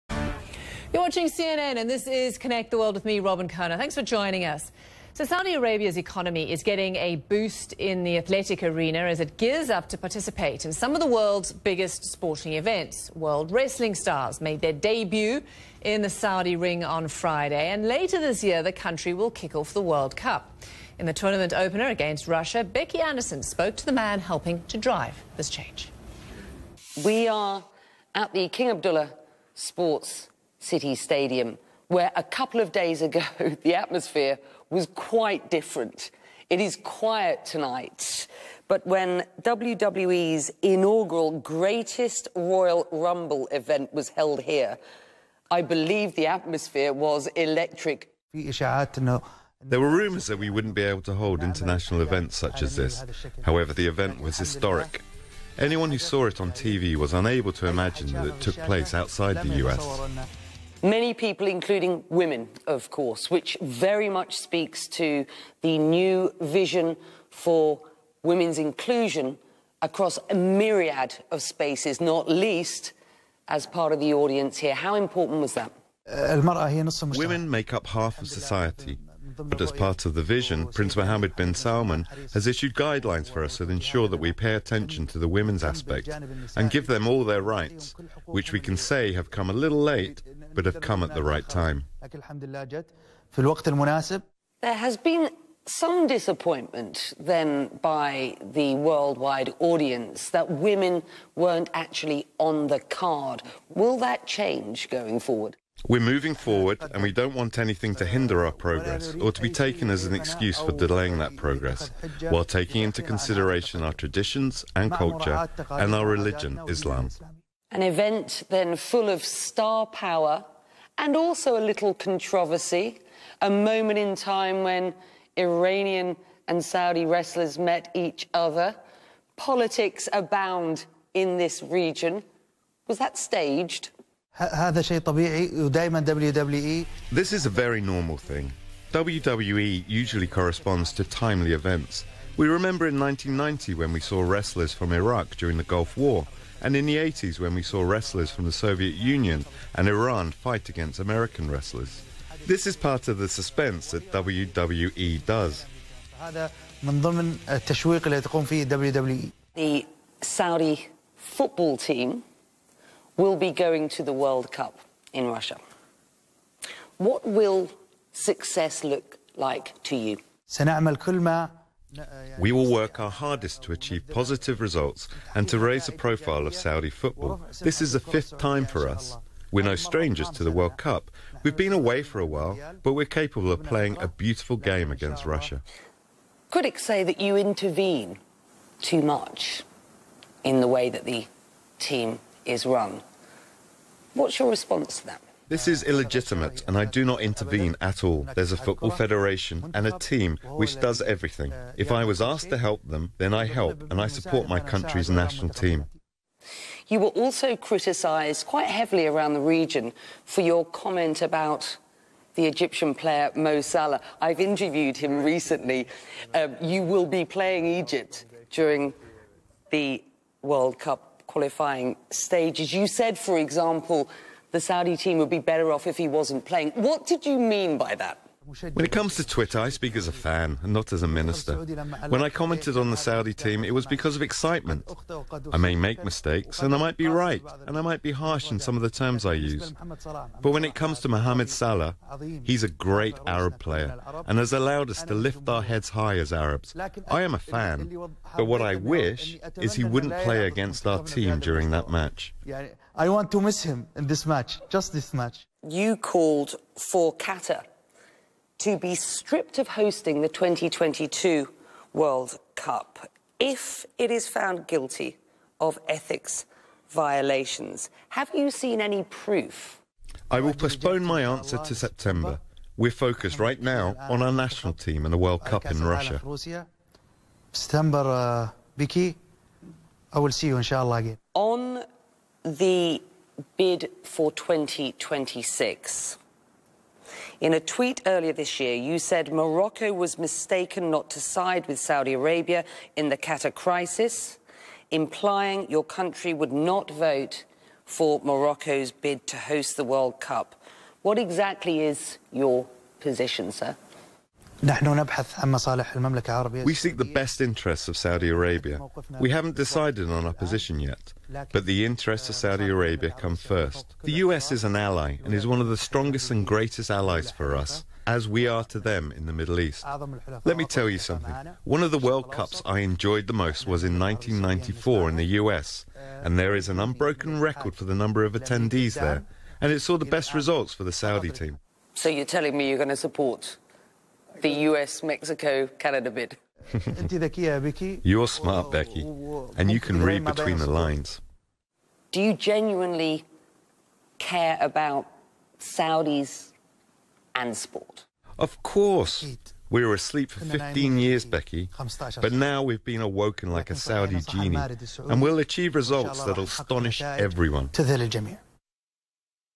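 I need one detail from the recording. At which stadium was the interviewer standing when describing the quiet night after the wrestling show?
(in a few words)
King Abdullah Sports City Stadium.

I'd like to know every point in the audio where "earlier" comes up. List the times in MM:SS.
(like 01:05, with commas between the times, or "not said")
04:48.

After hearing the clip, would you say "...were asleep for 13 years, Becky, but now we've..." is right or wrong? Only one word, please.
wrong.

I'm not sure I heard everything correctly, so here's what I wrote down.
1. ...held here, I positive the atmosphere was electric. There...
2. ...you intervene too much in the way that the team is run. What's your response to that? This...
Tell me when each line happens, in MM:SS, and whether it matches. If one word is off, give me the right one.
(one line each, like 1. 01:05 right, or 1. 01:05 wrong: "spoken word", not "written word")
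1. 00:44 wrong: "believe", not "positive"
2. 03:07 right.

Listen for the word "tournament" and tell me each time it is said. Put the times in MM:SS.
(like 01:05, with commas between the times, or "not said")
00:21.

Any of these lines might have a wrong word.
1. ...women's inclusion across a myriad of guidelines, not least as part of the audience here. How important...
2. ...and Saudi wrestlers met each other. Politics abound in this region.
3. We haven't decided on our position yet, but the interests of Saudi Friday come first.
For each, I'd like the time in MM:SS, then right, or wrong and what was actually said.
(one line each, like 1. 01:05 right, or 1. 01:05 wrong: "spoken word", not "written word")
1. 01:08 wrong: "spaces", not "guidelines"
2. 02:06 right
3. 05:09 wrong: "Arabia", not "Friday".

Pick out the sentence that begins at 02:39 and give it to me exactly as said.
The Saudi football team will be going to the World Cup in Russia.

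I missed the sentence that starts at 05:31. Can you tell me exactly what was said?
So you're telling me you're going to support the US Mexico Canada bid.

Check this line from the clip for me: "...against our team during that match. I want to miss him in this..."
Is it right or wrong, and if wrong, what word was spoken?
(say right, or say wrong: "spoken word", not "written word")
right.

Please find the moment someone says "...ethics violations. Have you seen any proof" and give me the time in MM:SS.
04:25.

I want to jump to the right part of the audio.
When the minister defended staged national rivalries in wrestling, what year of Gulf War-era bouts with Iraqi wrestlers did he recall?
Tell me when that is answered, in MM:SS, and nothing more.
02:22.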